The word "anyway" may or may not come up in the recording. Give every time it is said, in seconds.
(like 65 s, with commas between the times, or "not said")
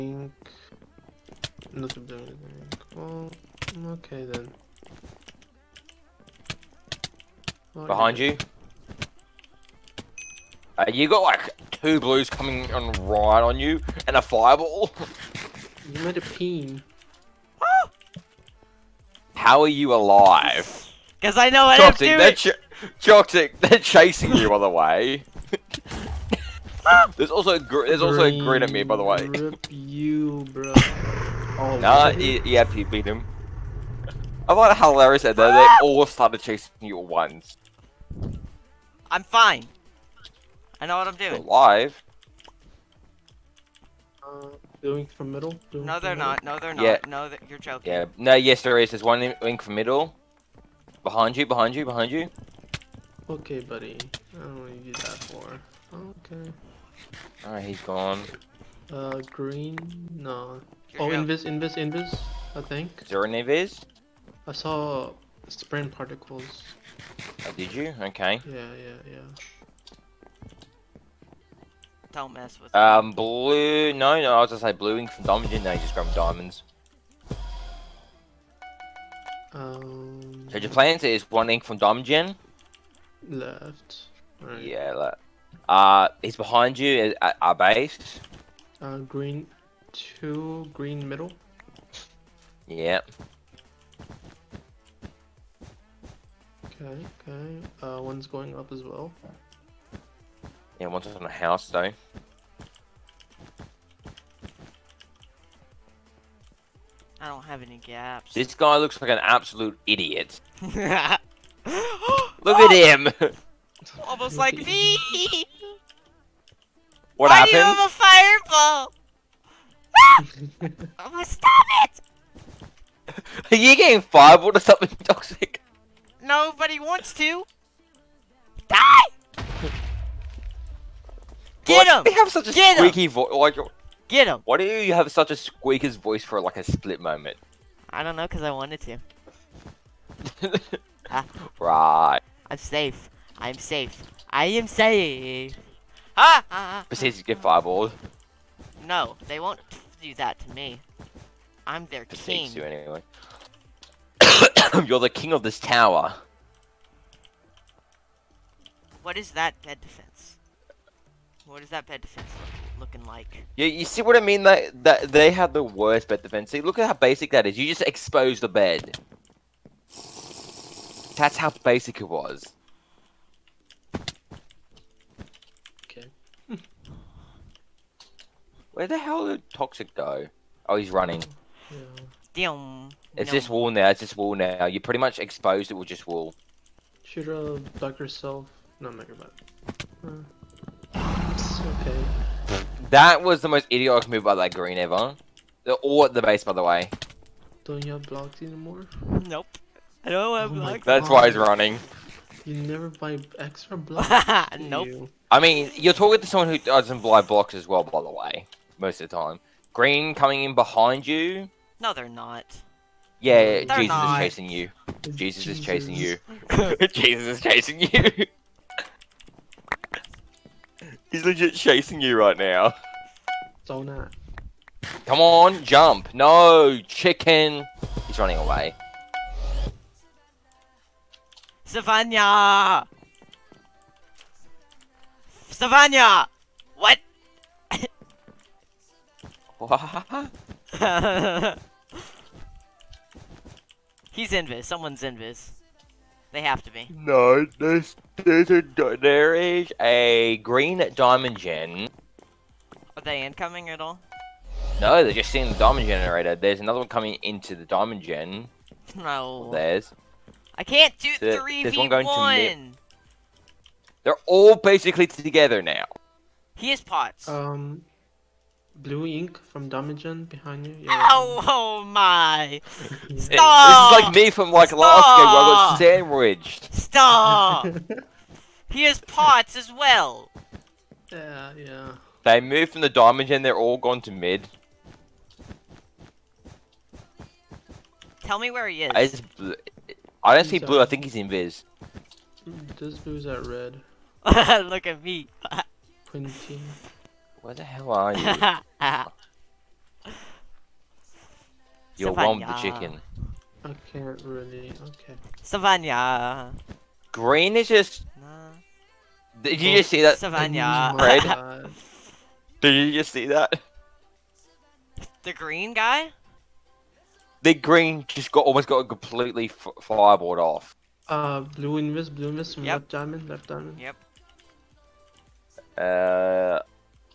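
152 s.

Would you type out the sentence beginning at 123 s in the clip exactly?
Are you getting fireballed or something toxic?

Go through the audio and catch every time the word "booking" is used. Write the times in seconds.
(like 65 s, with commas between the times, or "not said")
not said.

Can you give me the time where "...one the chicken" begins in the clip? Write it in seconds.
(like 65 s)
302 s.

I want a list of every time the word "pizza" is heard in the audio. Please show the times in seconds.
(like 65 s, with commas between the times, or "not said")
not said.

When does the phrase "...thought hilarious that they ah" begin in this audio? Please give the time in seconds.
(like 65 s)
34 s.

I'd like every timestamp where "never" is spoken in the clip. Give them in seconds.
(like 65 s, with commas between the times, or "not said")
188 s, 202 s.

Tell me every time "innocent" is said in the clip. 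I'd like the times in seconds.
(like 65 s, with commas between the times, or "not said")
not said.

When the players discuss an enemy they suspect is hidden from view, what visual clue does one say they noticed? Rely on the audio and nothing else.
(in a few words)
Sprint particles.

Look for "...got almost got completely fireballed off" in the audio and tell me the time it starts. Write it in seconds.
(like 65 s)
318 s.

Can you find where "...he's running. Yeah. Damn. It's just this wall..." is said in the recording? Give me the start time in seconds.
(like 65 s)
180 s.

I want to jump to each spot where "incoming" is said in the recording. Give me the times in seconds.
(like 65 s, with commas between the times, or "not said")
253 s.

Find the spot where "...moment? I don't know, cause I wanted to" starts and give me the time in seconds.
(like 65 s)
136 s.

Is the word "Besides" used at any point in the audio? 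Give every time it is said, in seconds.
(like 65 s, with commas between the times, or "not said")
146 s, 152 s.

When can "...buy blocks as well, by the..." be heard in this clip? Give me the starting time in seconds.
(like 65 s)
207 s.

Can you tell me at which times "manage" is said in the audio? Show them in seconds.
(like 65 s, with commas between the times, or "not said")
not said.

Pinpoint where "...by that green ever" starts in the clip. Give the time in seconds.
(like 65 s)
194 s.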